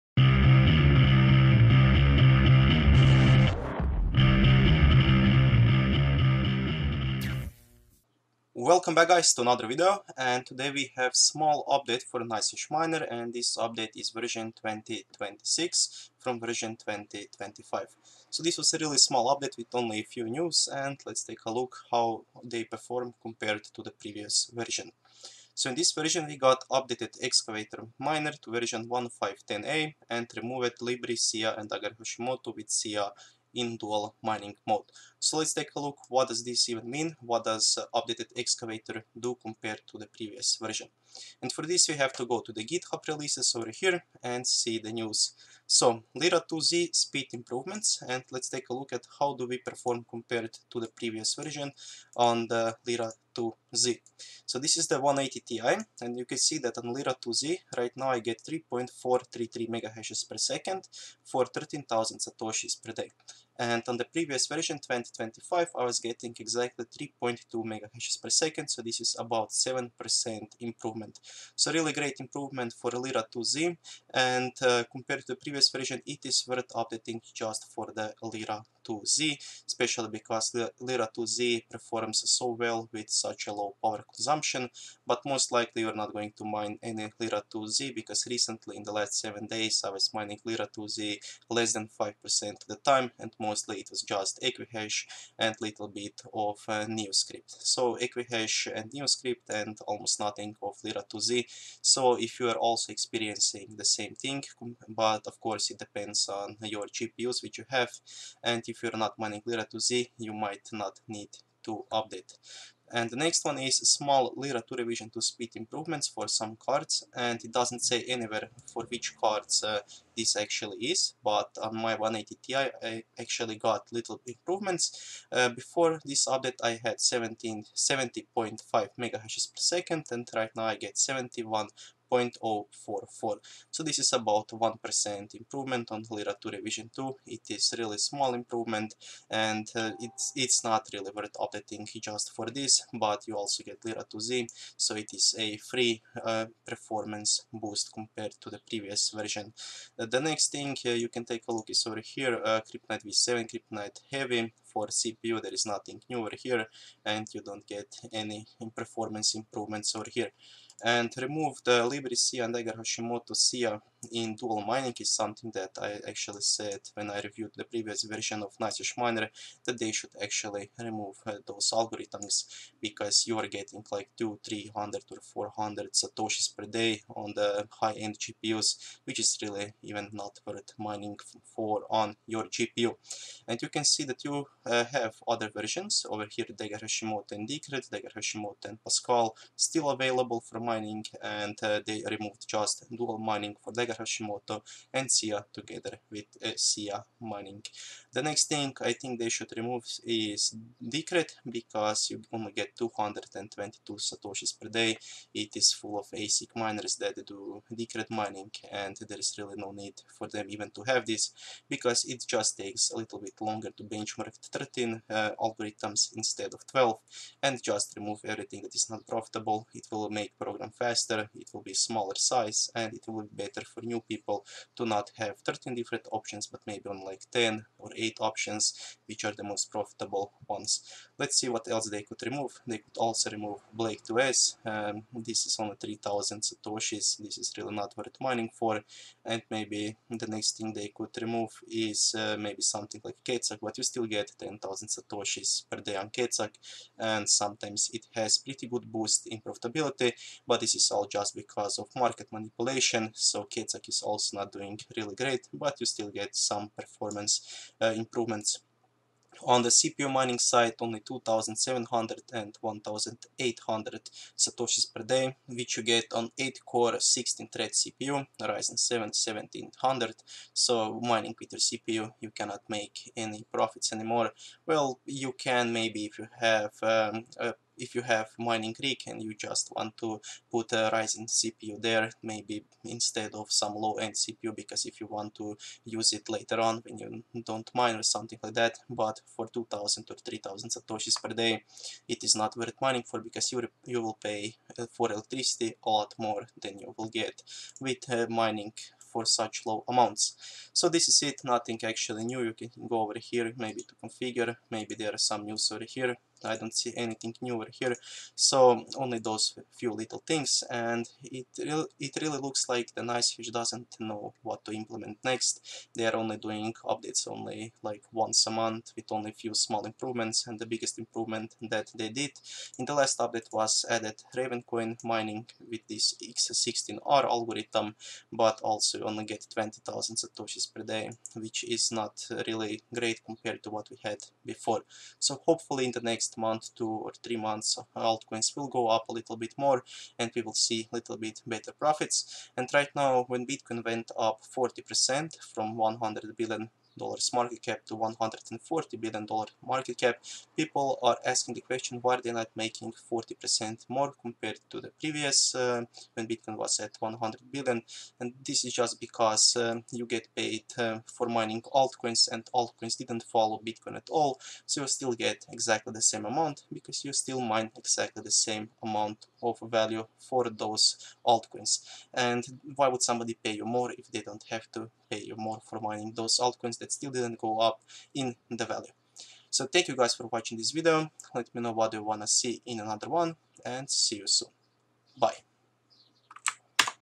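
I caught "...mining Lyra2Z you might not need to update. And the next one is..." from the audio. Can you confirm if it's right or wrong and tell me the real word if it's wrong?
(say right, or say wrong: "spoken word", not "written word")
right.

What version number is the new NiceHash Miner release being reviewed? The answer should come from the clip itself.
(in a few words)
2026.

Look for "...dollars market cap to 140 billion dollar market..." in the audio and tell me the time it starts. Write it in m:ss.
5:46.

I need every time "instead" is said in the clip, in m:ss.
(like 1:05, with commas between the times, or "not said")
3:36, 4:42.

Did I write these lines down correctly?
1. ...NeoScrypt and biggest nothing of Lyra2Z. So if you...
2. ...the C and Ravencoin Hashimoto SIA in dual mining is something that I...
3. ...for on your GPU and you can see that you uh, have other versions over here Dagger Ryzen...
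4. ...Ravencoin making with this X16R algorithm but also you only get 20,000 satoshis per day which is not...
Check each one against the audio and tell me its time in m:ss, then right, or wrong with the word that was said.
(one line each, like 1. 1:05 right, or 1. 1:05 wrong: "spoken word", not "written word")
1. 1:38 wrong: "almost", not "biggest"
2. 2:41 wrong: "Dagger", not "Ravencoin"
3. 3:01 wrong: "Hashimoto", not "Ryzen"
4. 5:24 wrong: "mining", not "making".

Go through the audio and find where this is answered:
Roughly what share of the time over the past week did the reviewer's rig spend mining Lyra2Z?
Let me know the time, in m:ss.
1:31.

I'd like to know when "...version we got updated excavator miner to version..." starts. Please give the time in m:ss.
0:25.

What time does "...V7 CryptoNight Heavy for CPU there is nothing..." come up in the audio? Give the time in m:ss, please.
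2:33.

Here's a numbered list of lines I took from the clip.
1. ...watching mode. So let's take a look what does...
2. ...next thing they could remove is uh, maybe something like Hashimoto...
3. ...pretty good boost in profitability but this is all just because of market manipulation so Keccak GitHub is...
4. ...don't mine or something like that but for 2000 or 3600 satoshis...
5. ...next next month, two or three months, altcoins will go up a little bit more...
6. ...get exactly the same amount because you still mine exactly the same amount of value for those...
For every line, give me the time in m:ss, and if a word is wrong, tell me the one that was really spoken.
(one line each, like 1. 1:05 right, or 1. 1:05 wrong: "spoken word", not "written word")
1. 0:34 wrong: "mining", not "watching"
2. 4:00 wrong: "Keccak", not "Hashimoto"
3. 4:08 wrong: "Itzhak", not "GitHub"
4. 4:47 wrong: "3000", not "3600"
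5. 5:36 right
6. 6:05 right.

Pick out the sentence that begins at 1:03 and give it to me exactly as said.
And on the previous version, 2025, I was getting exactly 3.2 megahashes per second, so this is about 7% improvement.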